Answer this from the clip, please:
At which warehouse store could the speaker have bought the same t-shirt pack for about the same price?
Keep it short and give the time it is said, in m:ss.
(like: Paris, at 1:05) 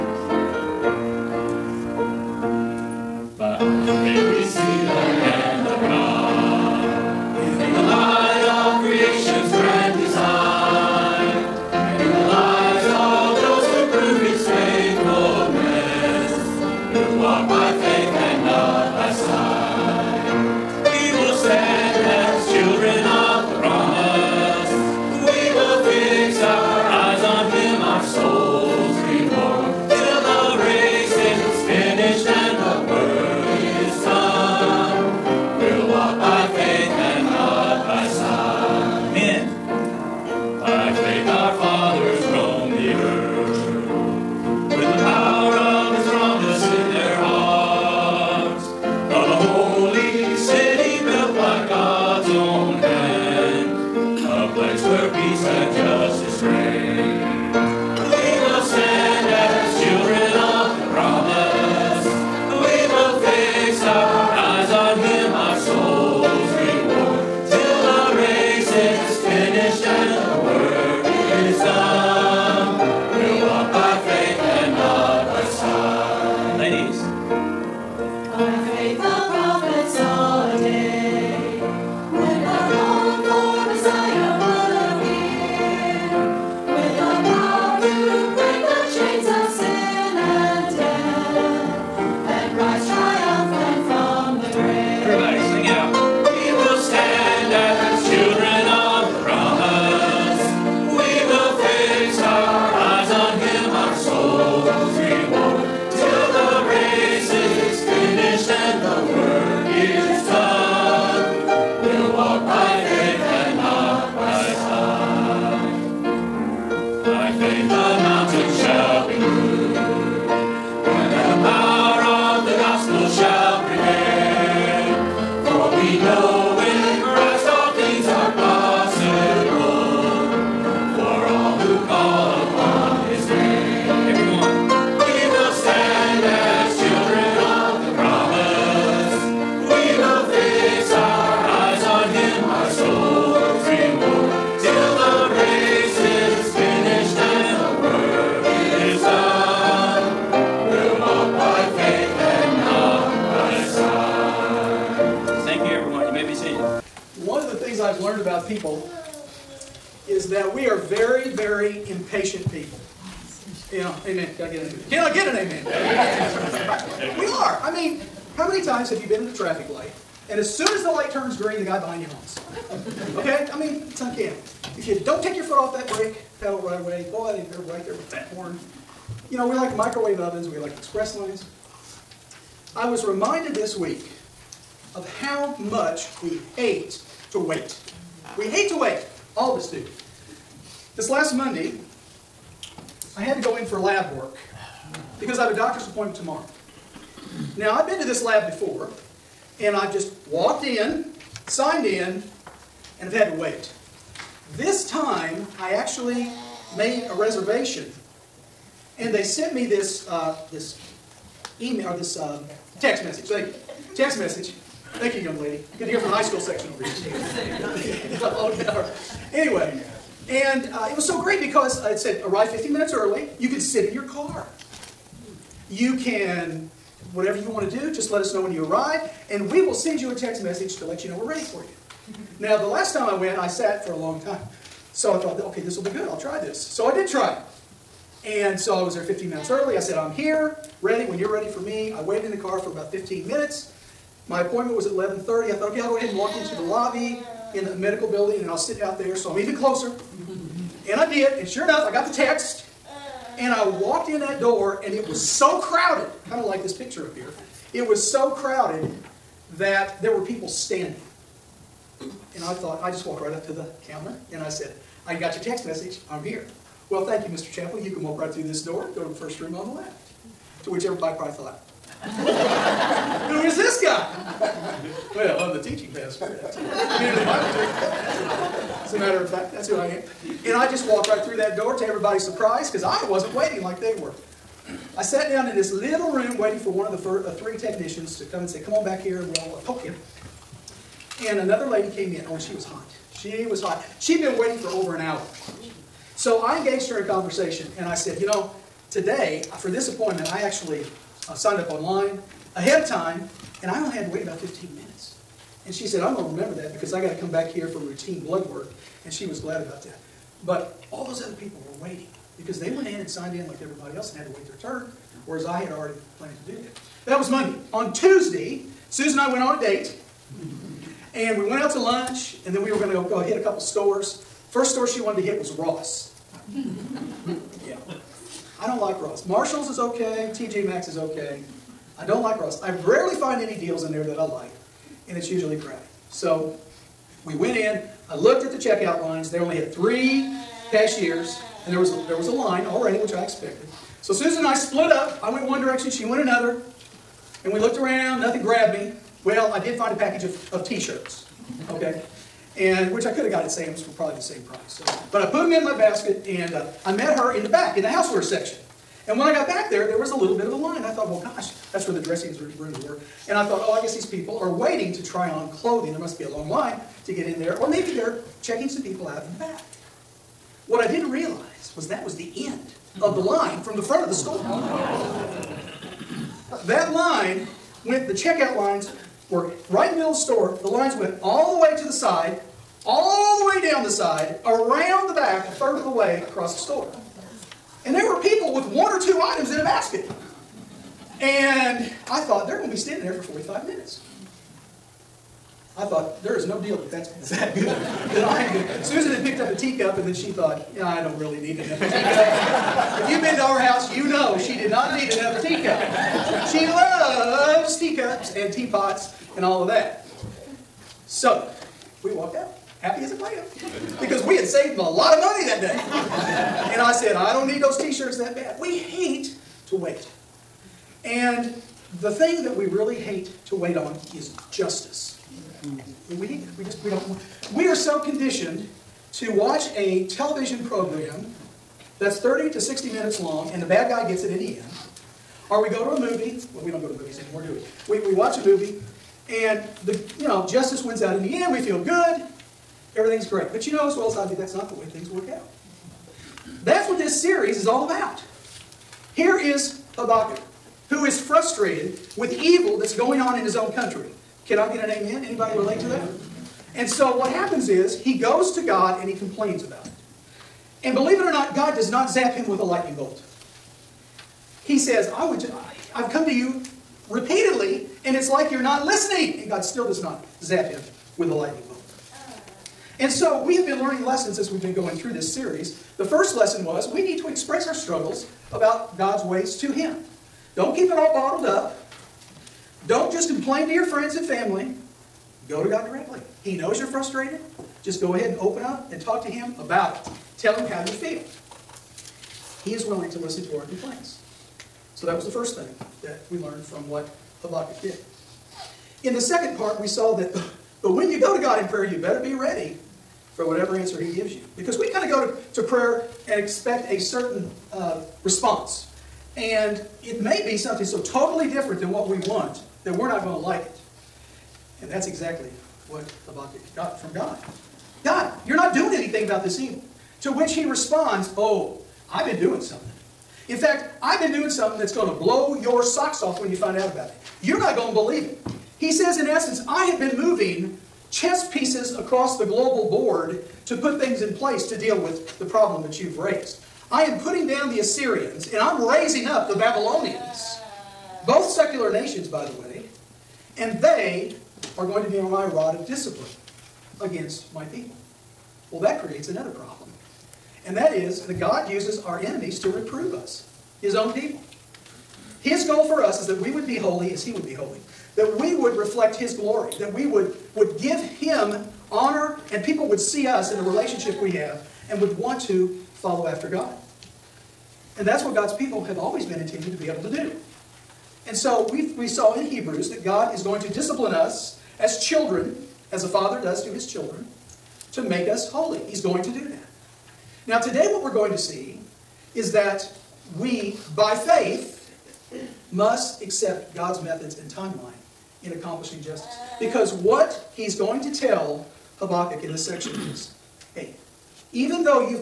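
Sam's, at 5:53.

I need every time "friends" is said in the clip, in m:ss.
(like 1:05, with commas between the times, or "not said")
8:03.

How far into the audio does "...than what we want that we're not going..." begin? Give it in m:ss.
8:31.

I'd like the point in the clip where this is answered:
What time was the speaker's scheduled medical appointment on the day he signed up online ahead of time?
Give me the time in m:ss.
4:04.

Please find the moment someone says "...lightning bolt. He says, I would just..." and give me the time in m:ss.
7:42.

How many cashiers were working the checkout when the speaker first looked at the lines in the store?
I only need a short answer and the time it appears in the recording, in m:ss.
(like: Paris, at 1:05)
3, at 5:39.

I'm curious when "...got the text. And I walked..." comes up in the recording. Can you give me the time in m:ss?
4:11.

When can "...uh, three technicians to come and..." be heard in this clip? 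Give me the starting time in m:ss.
4:47.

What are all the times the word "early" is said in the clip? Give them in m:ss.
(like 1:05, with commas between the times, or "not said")
3:42, 3:59.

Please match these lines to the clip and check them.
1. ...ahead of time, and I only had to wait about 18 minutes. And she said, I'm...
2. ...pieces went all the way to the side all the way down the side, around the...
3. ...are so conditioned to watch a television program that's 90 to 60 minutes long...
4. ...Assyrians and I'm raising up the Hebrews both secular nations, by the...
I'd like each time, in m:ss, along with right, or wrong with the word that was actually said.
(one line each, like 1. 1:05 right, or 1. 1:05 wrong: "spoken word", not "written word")
1. 5:02 wrong: "15", not "18"
2. 6:20 wrong: "lines", not "pieces"
3. 7:07 wrong: "30", not "90"
4. 8:57 wrong: "Babylonians", not "Hebrews".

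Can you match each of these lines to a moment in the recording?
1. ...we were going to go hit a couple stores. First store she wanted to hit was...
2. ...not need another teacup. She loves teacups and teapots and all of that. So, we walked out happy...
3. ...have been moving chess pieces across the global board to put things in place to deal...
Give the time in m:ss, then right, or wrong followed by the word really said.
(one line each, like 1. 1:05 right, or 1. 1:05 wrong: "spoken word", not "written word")
1. 5:22 right
2. 6:44 right
3. 8:49 right.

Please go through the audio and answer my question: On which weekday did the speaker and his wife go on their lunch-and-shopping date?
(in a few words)
Tuesday.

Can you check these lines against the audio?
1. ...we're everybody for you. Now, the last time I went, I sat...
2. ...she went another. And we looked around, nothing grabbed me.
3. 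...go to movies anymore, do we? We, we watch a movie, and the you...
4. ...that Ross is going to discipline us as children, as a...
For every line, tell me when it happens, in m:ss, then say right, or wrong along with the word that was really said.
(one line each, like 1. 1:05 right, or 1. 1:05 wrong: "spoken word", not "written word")
1. 3:51 wrong: "ready", not "everybody"
2. 5:45 right
3. 7:16 right
4. 9:32 wrong: "God", not "Ross".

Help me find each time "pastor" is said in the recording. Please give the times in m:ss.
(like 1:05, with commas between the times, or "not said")
4:35.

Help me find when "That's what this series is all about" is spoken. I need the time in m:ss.
7:26.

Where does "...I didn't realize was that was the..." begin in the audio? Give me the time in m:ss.
6:10.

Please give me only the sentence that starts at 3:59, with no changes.
I said, I'm here, ready when you're ready for me.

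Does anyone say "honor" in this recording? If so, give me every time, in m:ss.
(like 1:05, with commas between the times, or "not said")
9:21.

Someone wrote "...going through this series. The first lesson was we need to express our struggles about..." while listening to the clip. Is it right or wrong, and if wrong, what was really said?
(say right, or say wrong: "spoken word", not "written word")
right.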